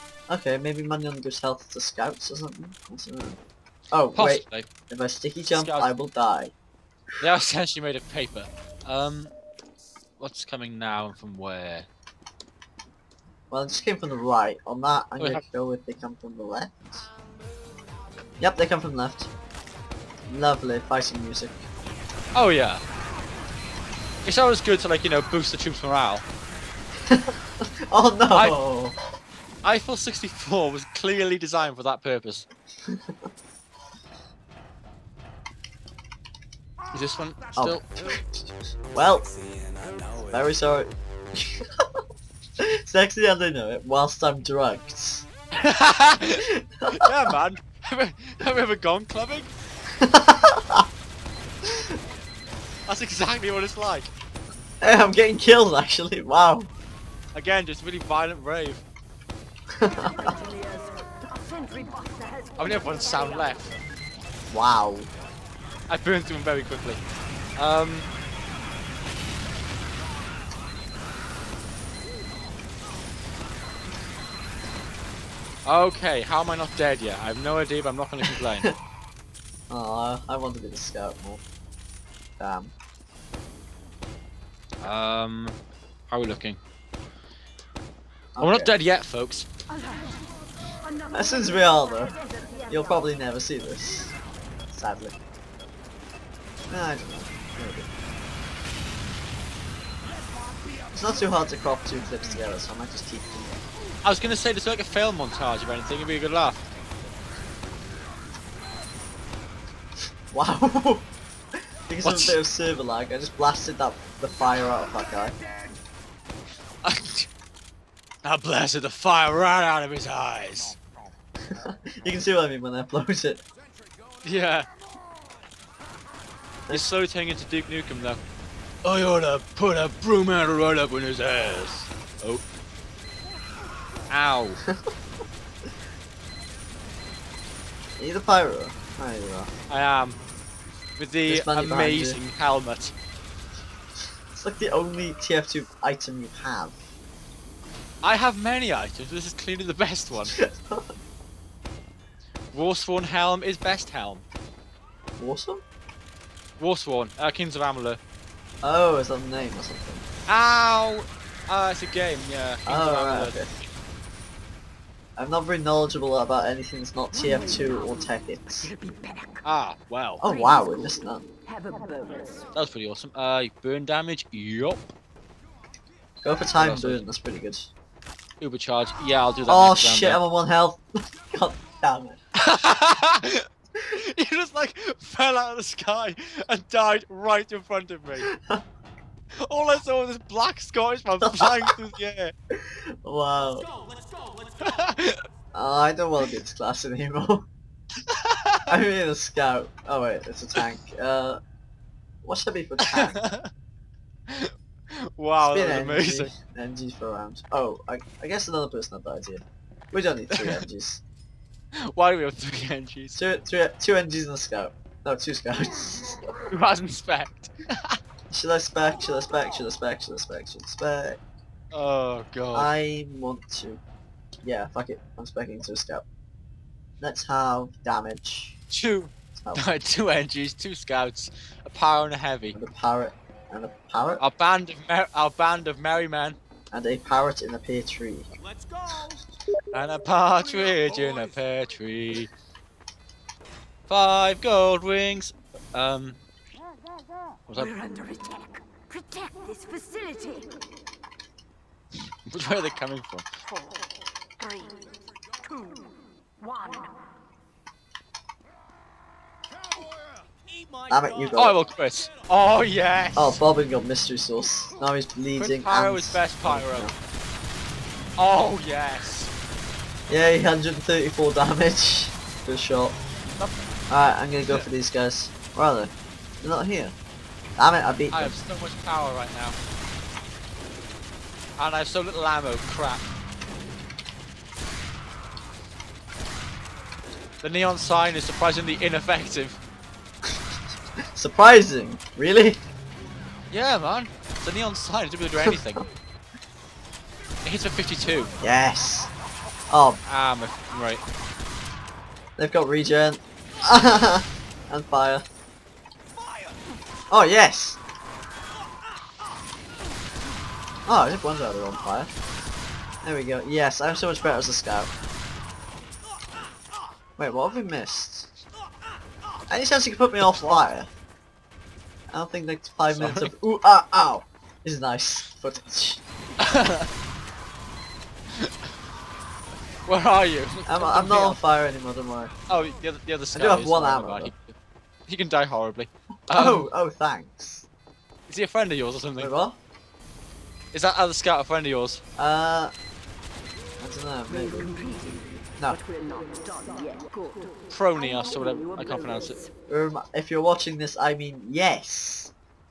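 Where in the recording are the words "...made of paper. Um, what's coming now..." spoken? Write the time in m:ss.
0:07.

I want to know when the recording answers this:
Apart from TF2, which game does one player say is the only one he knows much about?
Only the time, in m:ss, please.
2:47.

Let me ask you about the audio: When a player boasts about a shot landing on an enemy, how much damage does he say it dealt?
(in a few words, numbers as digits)
134.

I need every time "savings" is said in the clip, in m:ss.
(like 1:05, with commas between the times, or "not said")
not said.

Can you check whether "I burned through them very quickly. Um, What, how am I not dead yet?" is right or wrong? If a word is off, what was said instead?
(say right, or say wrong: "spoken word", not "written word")
wrong: "Okay", not "What".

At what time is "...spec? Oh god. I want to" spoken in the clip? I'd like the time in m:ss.
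3:40.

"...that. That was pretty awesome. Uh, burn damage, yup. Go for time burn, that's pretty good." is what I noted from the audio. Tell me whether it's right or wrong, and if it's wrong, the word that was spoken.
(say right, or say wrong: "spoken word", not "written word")
right.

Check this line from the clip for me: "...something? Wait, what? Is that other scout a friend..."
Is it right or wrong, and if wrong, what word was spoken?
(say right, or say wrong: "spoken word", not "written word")
right.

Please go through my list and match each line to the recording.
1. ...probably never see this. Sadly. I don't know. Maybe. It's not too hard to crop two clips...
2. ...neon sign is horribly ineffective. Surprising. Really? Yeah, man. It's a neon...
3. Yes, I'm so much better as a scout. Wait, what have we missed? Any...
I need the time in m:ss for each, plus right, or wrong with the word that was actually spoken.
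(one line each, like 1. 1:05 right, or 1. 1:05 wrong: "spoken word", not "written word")
1. 1:32 right
2. 4:47 wrong: "surprisingly", not "horribly"
3. 5:13 right.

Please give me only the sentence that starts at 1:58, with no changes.
I blasted the fire right out of his eyes.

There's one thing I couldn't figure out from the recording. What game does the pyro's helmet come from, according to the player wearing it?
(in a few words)
Kings of Amalur.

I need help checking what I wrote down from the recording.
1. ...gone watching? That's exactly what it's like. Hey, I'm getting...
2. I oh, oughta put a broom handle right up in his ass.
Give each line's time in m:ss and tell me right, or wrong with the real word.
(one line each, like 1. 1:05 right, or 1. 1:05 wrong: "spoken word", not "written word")
1. 0:48 wrong: "clubbing", not "watching"
2. 2:08 right.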